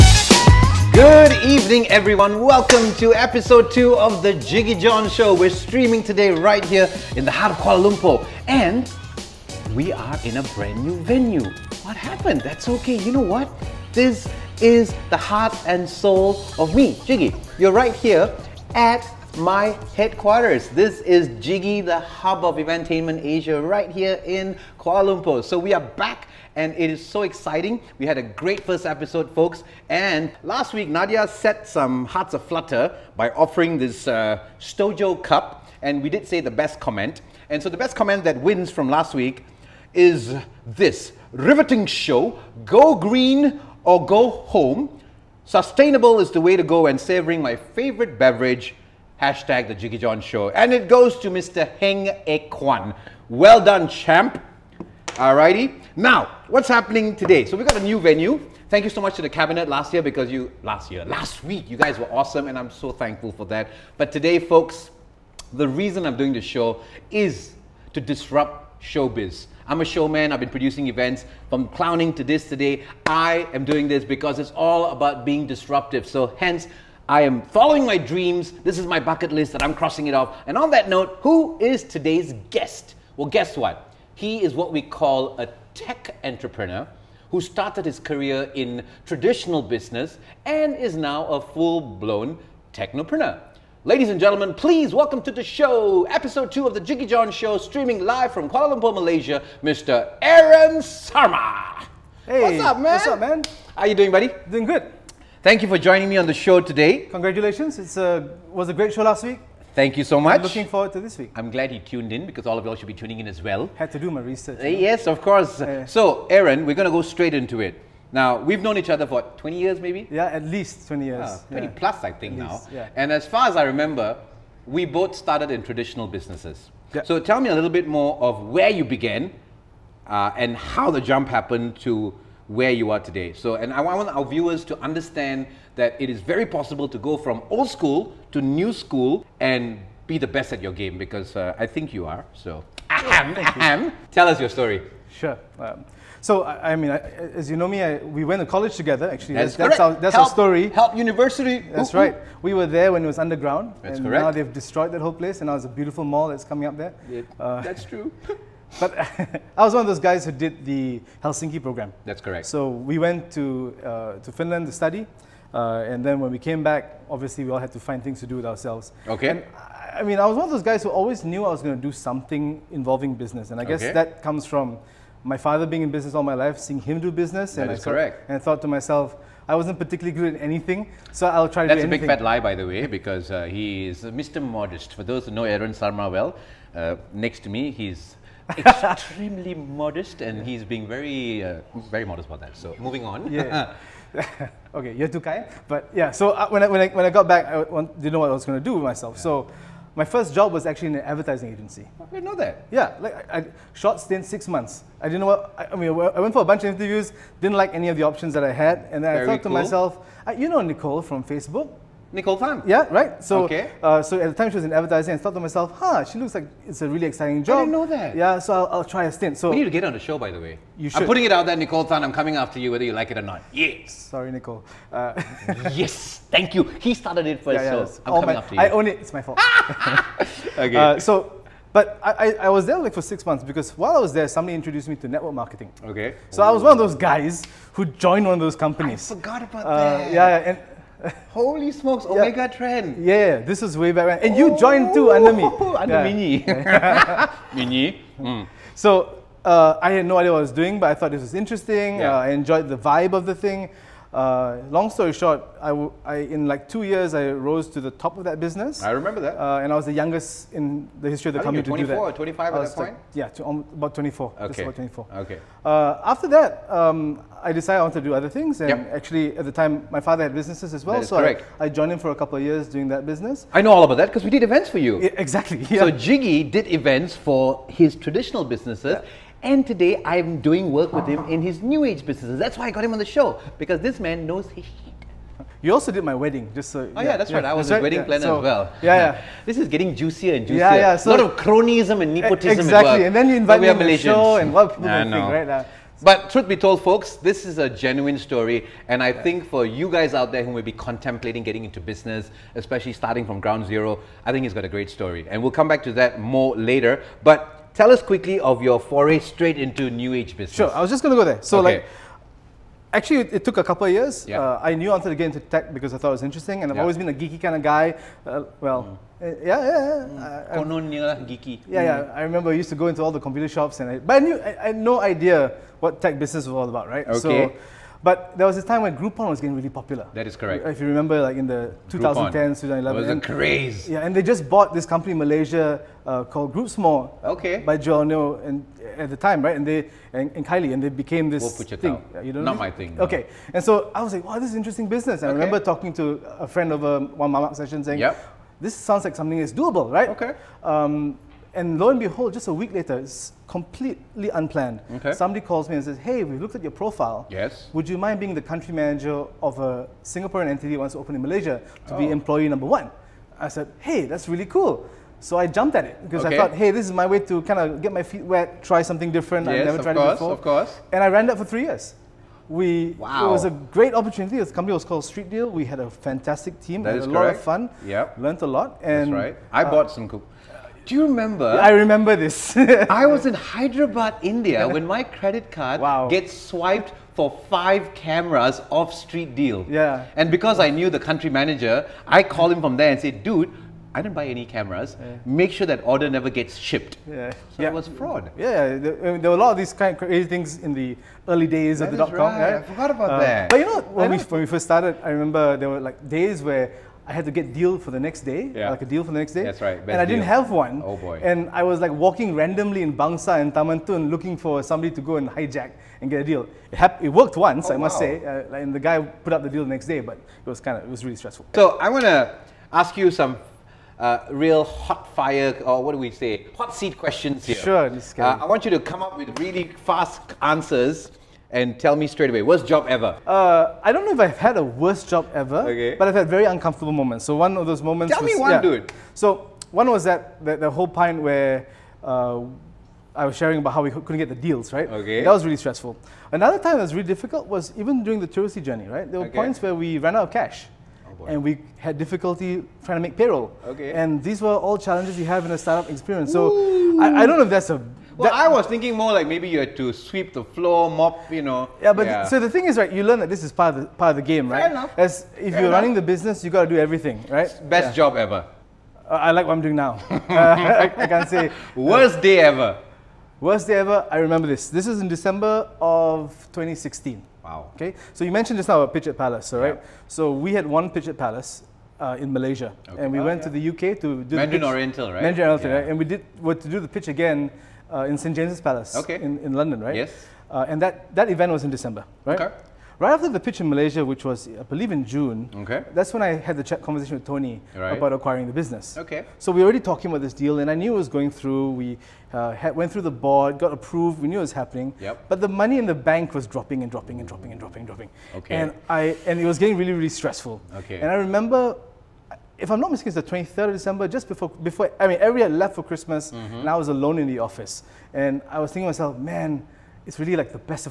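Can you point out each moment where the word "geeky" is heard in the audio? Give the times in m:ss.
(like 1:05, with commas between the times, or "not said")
5:17, 5:21.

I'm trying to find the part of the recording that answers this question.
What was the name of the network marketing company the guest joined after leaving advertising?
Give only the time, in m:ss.
4:02.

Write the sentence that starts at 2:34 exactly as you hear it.
now they've destroyed that whole place, and now it's a beautiful mall that's coming up there.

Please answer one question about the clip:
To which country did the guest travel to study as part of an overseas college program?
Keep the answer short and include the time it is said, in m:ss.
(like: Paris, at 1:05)
Finland, at 2:44.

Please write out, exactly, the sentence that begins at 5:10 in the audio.
Sure, I was just going to go there.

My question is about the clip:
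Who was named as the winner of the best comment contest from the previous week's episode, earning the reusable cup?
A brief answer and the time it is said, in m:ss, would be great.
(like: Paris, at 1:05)
Heng Ek Kwan, at 0:51.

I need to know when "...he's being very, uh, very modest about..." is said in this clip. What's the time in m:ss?
3:10.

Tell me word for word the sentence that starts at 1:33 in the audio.
Ladies and gentlemen, please welcome to the show, episode two of the Jiggee Jon Show, streaming live from Kuala Lumpur, Malaysia, Mr.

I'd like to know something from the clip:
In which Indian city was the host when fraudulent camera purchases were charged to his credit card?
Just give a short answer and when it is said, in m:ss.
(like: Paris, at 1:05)
Hyderabad, at 6:23.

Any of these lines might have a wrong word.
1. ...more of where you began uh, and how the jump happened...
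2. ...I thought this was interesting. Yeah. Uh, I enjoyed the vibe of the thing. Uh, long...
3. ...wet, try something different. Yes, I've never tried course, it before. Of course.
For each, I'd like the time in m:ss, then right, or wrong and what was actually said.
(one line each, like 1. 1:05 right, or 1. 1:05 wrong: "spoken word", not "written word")
1. 2:07 right
2. 4:10 right
3. 6:08 right.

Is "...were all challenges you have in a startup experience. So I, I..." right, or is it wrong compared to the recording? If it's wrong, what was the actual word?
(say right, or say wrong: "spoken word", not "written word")
right.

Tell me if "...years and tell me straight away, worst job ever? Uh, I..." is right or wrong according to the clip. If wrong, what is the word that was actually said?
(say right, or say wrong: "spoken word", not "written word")
wrong: "answers", not "years".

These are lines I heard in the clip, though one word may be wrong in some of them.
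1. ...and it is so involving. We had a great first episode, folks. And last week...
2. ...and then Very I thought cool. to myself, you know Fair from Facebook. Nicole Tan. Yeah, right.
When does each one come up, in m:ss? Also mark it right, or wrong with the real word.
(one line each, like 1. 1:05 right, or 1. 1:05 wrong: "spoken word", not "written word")
1. 0:26 wrong: "exciting", not "involving"
2. 3:28 wrong: "Nicole", not "Fair".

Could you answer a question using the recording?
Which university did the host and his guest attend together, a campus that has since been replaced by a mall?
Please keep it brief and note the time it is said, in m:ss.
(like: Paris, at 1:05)
Help University, at 2:30.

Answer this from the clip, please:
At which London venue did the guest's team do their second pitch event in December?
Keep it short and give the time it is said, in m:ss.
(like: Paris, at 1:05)
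St James's Palace, at 8:08.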